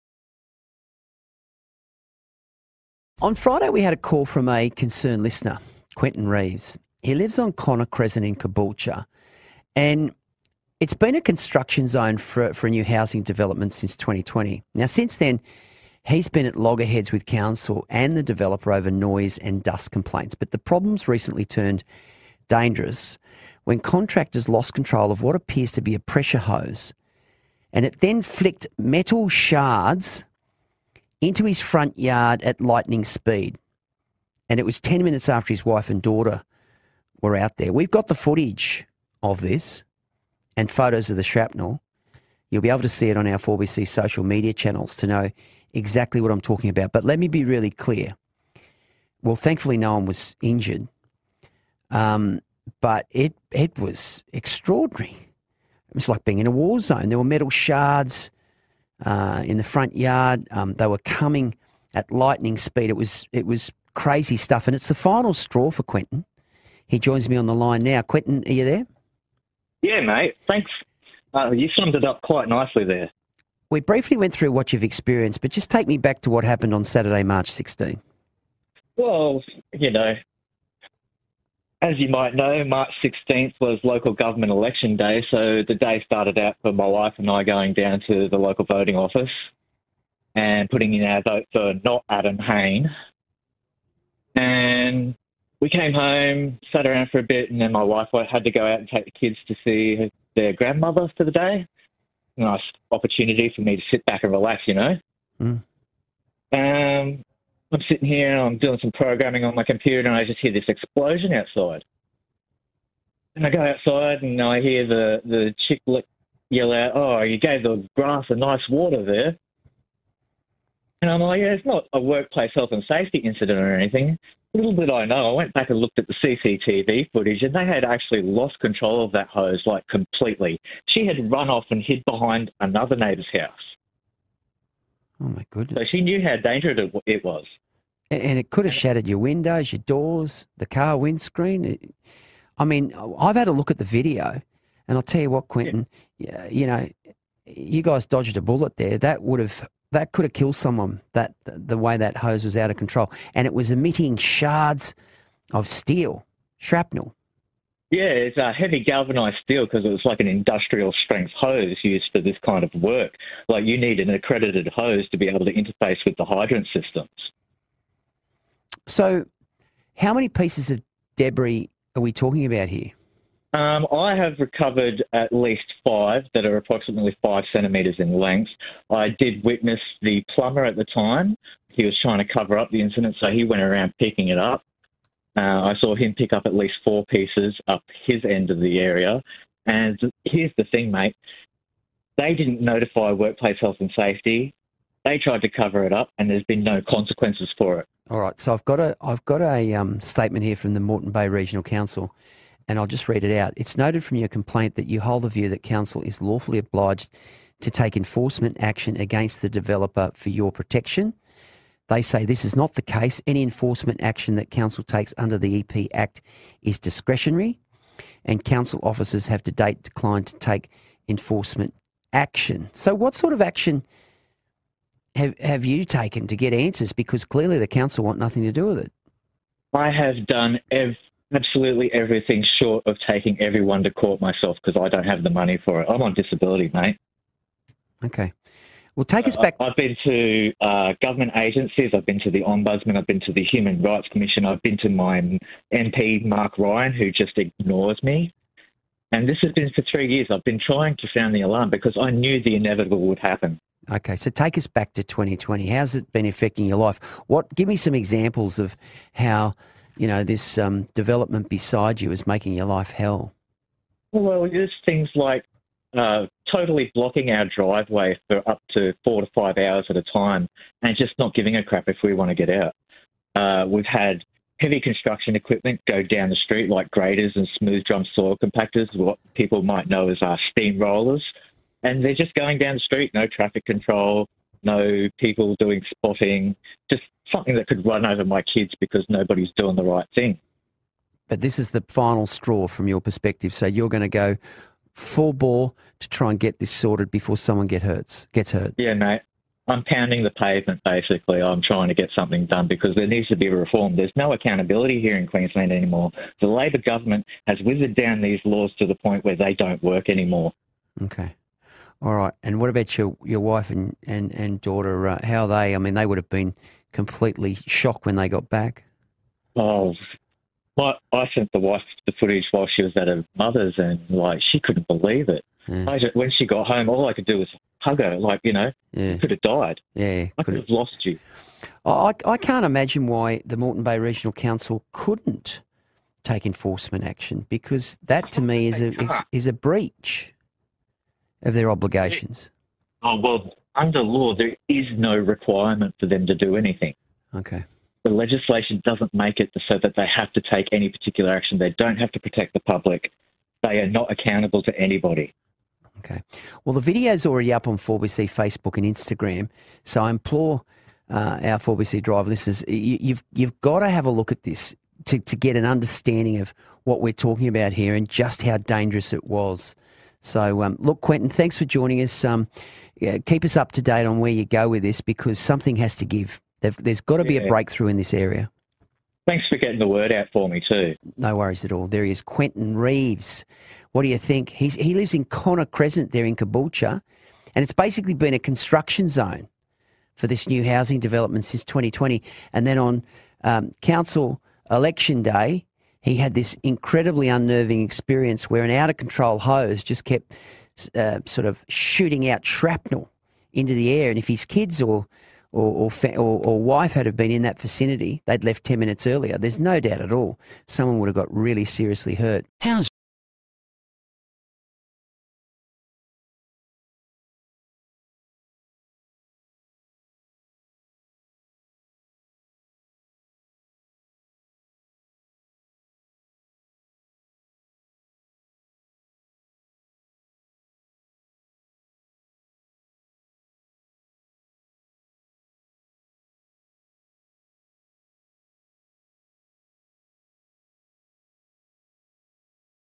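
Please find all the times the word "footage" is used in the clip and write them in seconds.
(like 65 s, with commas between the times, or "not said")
38 s, 127 s, 322 s.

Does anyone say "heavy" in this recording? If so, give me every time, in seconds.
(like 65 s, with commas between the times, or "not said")
158 s, 274 s.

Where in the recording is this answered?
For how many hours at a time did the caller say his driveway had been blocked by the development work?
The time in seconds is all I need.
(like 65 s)
269 s.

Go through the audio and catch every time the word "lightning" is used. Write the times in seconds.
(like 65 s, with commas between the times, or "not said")
32 s, 62 s.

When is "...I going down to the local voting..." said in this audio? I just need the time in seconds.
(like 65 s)
87 s.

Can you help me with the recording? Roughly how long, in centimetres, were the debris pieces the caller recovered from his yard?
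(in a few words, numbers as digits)
5 centimetres.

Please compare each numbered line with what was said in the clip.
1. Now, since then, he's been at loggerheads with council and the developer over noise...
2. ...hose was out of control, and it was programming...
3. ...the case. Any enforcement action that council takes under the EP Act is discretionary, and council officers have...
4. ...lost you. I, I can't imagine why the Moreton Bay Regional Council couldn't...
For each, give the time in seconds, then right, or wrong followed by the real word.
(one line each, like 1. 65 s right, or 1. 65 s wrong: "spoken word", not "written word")
1. 14 s right
2. 152 s wrong: "emitting", not "programming"
3. 212 s right
4. 330 s right.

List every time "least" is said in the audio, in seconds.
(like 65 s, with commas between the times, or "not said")
175 s, 186 s.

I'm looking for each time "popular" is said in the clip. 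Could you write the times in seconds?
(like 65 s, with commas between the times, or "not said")
not said.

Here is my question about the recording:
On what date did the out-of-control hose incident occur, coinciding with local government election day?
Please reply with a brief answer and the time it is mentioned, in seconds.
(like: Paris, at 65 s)
March 16, at 77 s.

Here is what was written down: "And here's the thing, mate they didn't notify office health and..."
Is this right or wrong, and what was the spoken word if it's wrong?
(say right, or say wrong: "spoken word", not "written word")
wrong: "workplace", not "office".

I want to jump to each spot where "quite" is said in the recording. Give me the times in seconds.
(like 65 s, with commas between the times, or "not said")
72 s.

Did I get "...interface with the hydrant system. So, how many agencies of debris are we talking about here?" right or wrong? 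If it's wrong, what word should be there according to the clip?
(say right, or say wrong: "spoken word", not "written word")
wrong: "pieces", not "agencies".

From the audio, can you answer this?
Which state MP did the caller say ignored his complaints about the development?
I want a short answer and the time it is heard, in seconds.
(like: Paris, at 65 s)
Mark Ryan, at 246 s.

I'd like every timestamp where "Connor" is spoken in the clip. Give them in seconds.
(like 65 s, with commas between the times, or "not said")
7 s, 385 s.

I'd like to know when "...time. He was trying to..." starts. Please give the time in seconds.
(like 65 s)
180 s.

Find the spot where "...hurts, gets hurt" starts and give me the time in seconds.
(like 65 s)
297 s.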